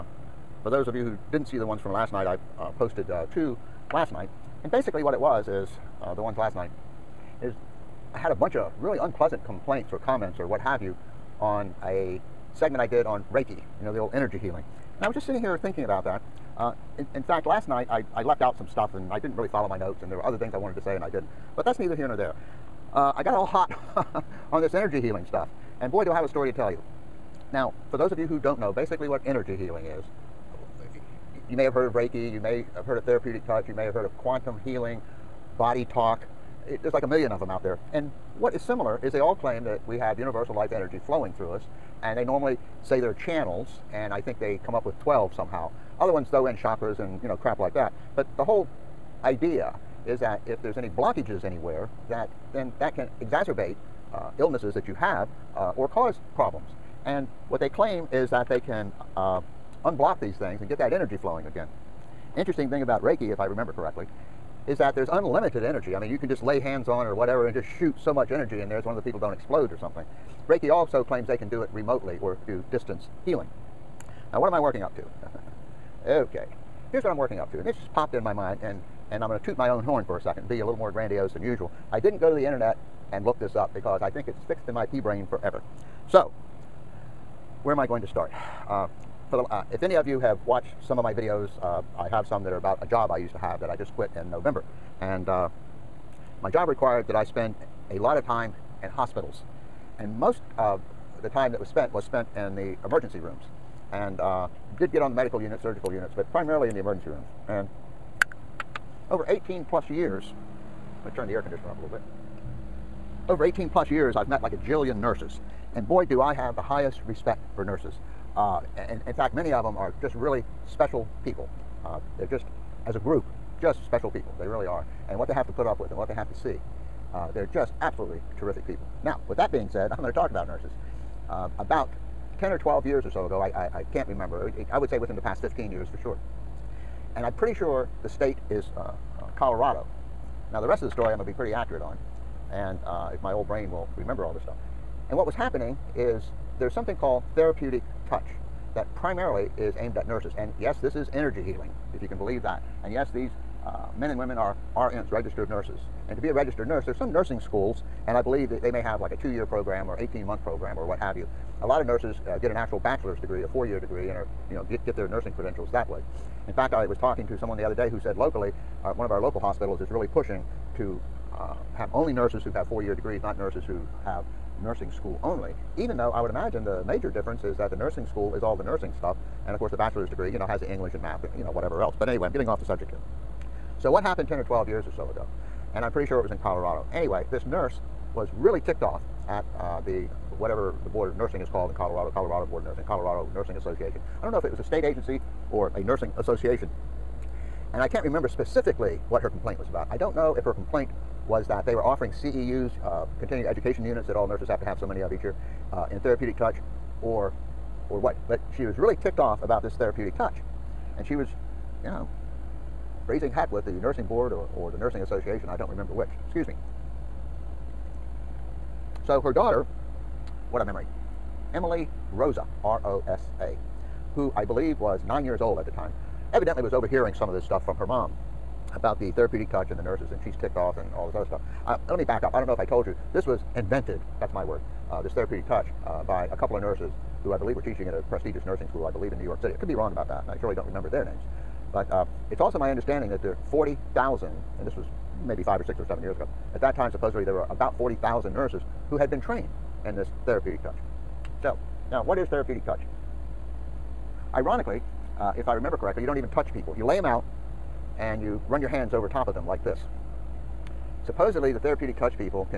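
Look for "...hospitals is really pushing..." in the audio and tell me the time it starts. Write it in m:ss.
2:49.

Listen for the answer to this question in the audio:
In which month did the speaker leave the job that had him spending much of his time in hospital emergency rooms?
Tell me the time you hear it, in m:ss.
1:34.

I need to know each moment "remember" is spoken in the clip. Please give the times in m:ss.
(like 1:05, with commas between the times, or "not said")
1:03, 2:14, 2:23, 3:18, 3:35, 4:00, 4:15.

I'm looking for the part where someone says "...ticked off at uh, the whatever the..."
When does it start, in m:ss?
3:08.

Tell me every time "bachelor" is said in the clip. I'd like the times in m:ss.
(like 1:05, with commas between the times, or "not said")
2:42, 2:59.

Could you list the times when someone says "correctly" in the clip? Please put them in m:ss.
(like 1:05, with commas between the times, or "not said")
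1:03, 4:15.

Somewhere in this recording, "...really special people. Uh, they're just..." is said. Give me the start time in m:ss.
2:00.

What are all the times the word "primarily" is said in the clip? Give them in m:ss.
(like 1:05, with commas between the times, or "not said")
1:46, 2:29.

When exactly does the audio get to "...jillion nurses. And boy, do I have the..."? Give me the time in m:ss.
1:54.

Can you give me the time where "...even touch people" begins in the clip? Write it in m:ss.
4:16.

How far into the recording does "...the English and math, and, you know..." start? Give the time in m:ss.
3:00.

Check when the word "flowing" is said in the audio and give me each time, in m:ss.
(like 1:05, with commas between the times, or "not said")
0:41, 1:01.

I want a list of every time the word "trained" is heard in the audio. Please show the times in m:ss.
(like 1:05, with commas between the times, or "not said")
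4:09.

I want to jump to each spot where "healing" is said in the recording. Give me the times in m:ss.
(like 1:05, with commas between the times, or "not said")
0:14, 0:25, 0:29, 0:34, 1:13, 2:31.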